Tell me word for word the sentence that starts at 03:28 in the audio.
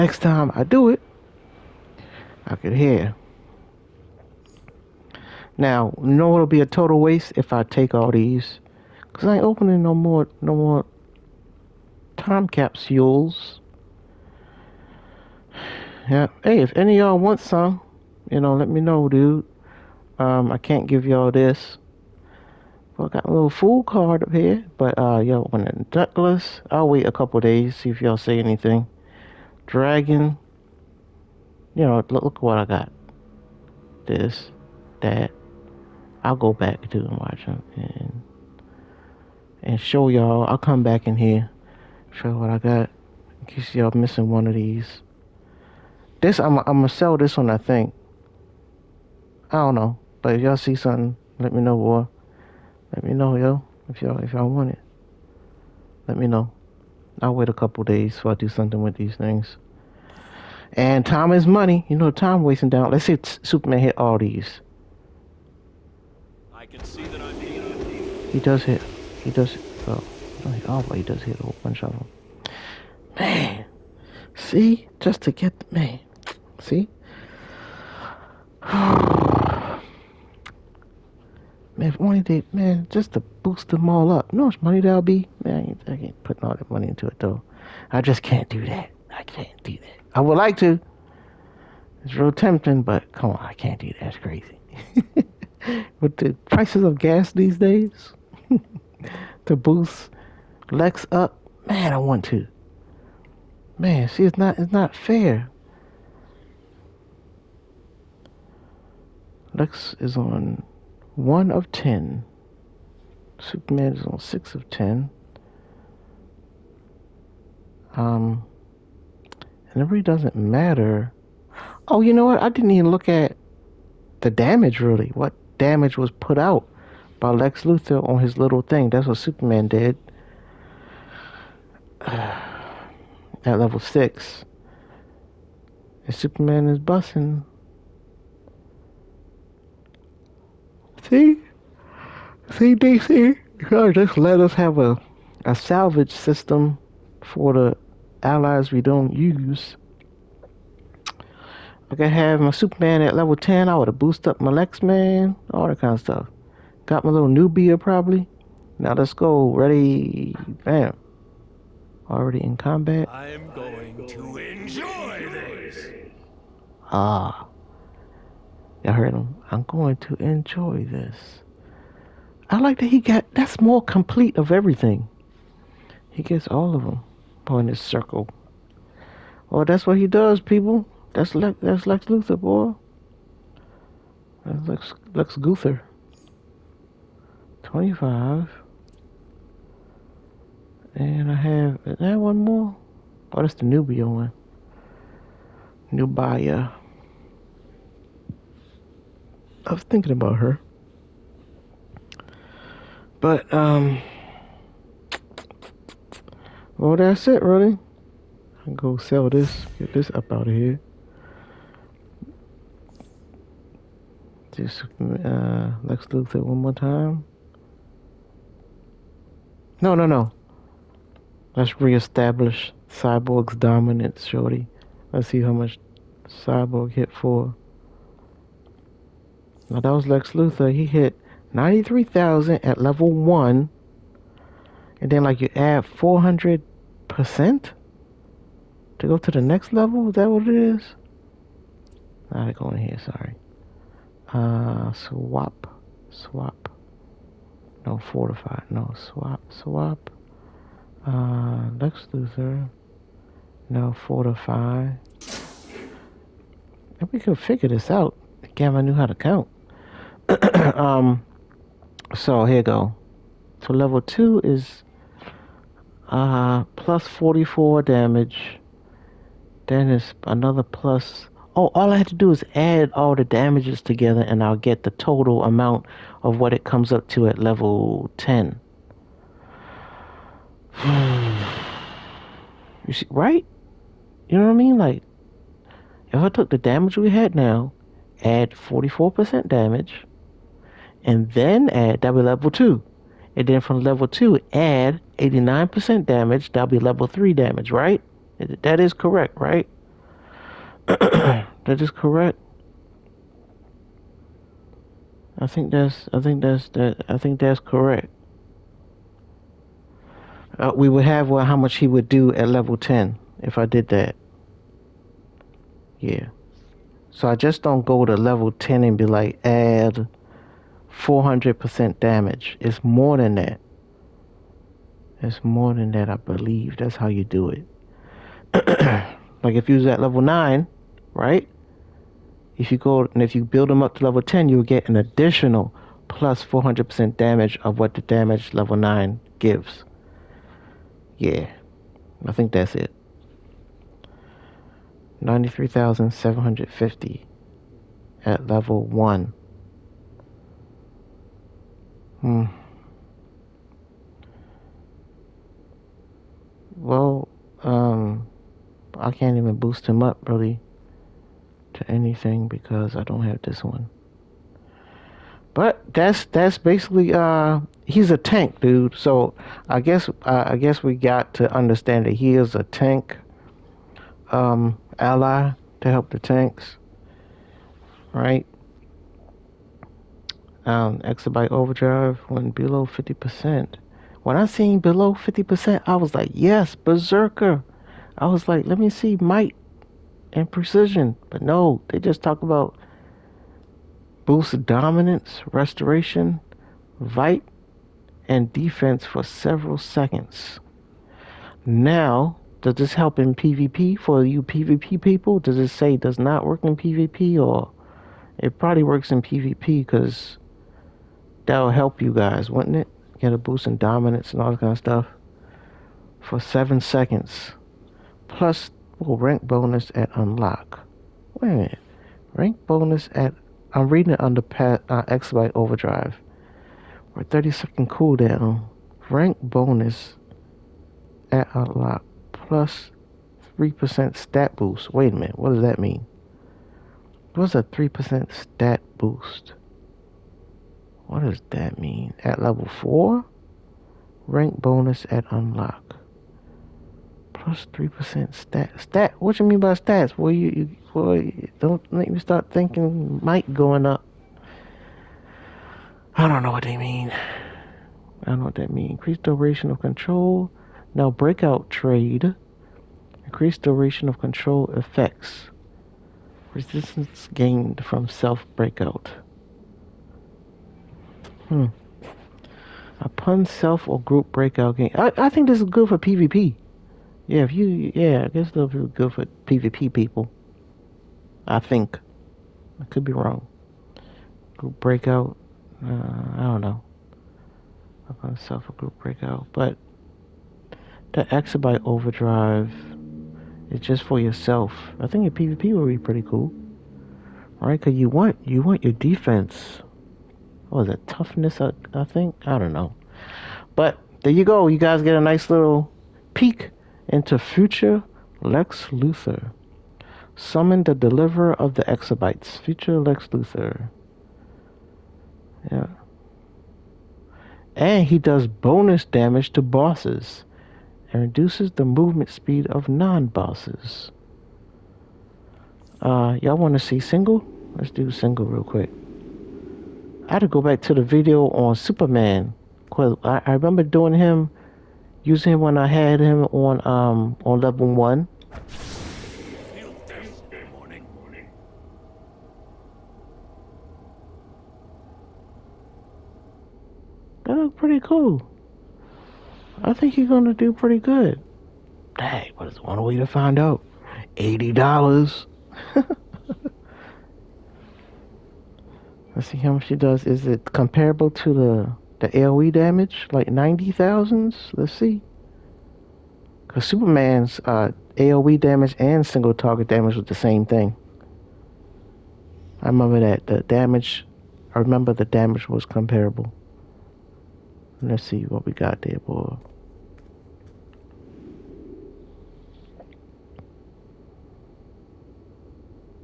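I can go sell this, get this up out of here.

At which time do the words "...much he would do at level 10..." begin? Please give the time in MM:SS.
05:11.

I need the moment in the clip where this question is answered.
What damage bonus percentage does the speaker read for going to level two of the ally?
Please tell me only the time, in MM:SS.
04:26.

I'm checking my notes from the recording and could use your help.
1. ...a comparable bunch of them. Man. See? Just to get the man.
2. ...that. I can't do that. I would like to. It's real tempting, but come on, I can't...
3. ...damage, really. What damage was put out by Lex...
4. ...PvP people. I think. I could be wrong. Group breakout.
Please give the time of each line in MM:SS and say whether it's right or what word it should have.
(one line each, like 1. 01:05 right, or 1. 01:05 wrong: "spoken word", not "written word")
1. 01:11 wrong: "whole", not "comparable"
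2. 01:28 right
3. 02:04 right
4. 07:59 right.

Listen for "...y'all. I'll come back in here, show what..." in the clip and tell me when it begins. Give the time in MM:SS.
00:40.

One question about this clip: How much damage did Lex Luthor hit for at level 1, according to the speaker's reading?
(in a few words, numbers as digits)
93,000.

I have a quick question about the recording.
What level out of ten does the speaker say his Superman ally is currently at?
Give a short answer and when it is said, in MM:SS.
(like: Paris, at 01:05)
6, at 01:53.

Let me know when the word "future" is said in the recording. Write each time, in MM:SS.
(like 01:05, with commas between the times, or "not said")
08:27, 08:32.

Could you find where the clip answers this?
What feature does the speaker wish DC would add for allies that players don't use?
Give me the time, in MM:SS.
02:25.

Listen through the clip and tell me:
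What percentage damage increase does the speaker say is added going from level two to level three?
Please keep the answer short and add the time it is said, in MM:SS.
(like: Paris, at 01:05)
89%, at 04:54.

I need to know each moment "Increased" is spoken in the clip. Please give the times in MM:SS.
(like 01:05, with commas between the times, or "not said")
07:38, 07:43.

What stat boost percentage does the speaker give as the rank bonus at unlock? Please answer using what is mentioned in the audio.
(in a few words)
3%.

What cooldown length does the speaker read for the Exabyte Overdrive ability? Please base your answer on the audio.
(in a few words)
30 seconds.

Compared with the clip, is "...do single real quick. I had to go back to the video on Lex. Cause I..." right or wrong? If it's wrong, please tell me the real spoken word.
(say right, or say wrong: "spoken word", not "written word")
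wrong: "Superman", not "Lex".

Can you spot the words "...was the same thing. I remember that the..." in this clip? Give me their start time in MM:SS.
09:30.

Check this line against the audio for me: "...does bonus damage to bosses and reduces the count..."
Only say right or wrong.
wrong.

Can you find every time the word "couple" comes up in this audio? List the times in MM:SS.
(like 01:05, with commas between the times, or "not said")
00:27, 00:57.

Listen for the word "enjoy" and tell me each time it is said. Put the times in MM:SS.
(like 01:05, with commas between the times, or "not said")
02:44, 02:50.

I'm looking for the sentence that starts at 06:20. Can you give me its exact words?
um, exabyte overdrive went below 50%.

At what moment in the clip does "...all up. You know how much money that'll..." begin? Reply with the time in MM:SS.
01:23.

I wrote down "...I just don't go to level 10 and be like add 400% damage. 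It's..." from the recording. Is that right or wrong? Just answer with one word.
right.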